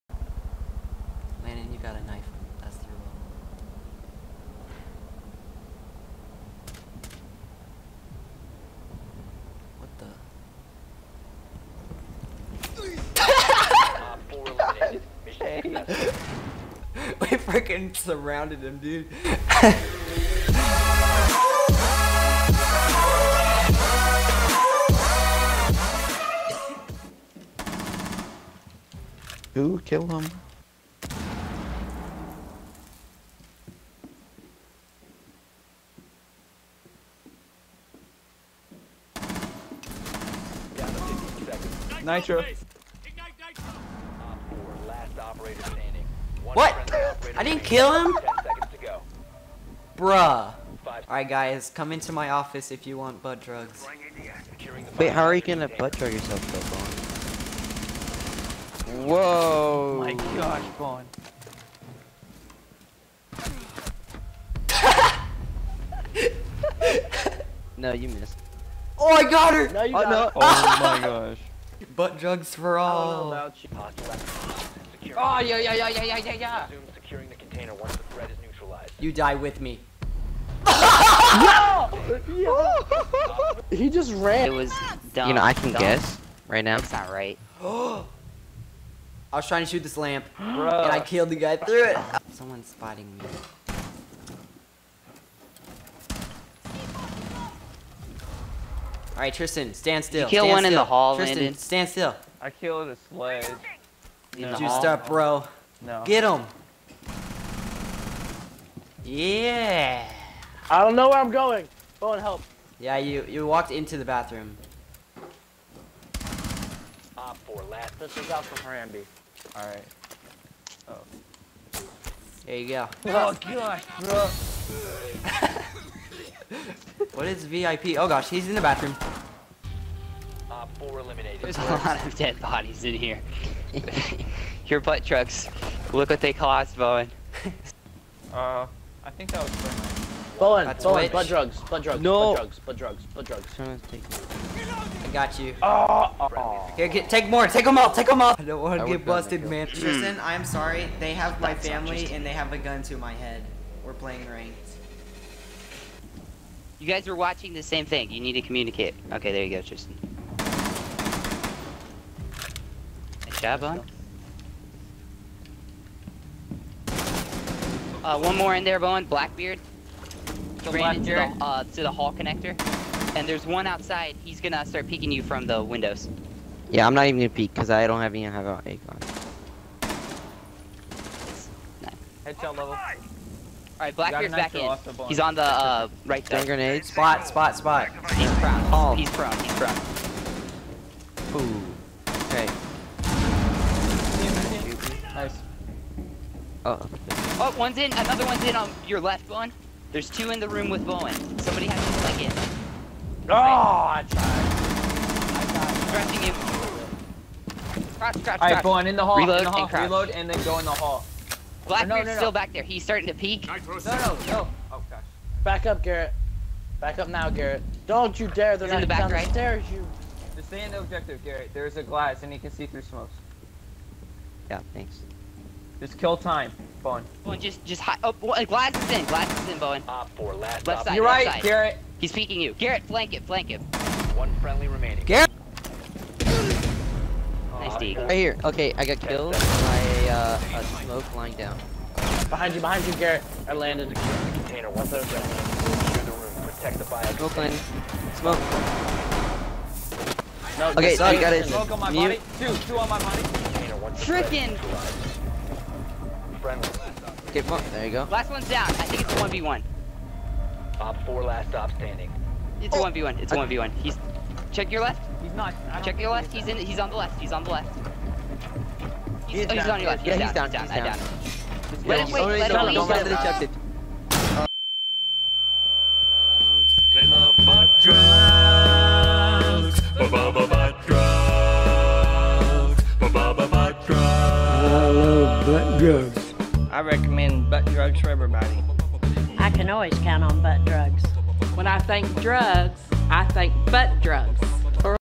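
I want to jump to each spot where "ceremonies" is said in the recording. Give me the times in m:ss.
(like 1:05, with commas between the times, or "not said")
not said.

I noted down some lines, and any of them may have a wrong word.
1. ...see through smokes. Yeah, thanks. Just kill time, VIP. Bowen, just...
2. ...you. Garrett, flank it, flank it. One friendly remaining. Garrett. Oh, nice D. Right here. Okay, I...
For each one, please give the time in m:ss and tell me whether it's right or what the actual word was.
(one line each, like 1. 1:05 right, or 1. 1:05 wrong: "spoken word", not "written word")
1. 3:42 wrong: "Bowen", not "VIP"
2. 3:52 right.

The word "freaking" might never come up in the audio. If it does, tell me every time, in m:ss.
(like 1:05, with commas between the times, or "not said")
0:17, 4:14.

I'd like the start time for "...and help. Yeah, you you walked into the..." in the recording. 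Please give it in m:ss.
1:52.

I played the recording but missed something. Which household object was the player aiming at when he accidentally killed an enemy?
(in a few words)
lamp.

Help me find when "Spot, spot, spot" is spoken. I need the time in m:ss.
3:06.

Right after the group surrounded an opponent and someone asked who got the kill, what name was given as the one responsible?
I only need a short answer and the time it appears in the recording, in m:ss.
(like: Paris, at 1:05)
Nitro, at 0:42.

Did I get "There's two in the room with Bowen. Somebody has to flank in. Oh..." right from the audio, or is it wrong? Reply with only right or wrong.
right.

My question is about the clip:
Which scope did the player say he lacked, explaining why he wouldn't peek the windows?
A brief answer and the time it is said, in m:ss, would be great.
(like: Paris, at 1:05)
ACOG, at 2:58.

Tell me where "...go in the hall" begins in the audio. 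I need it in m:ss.
3:30.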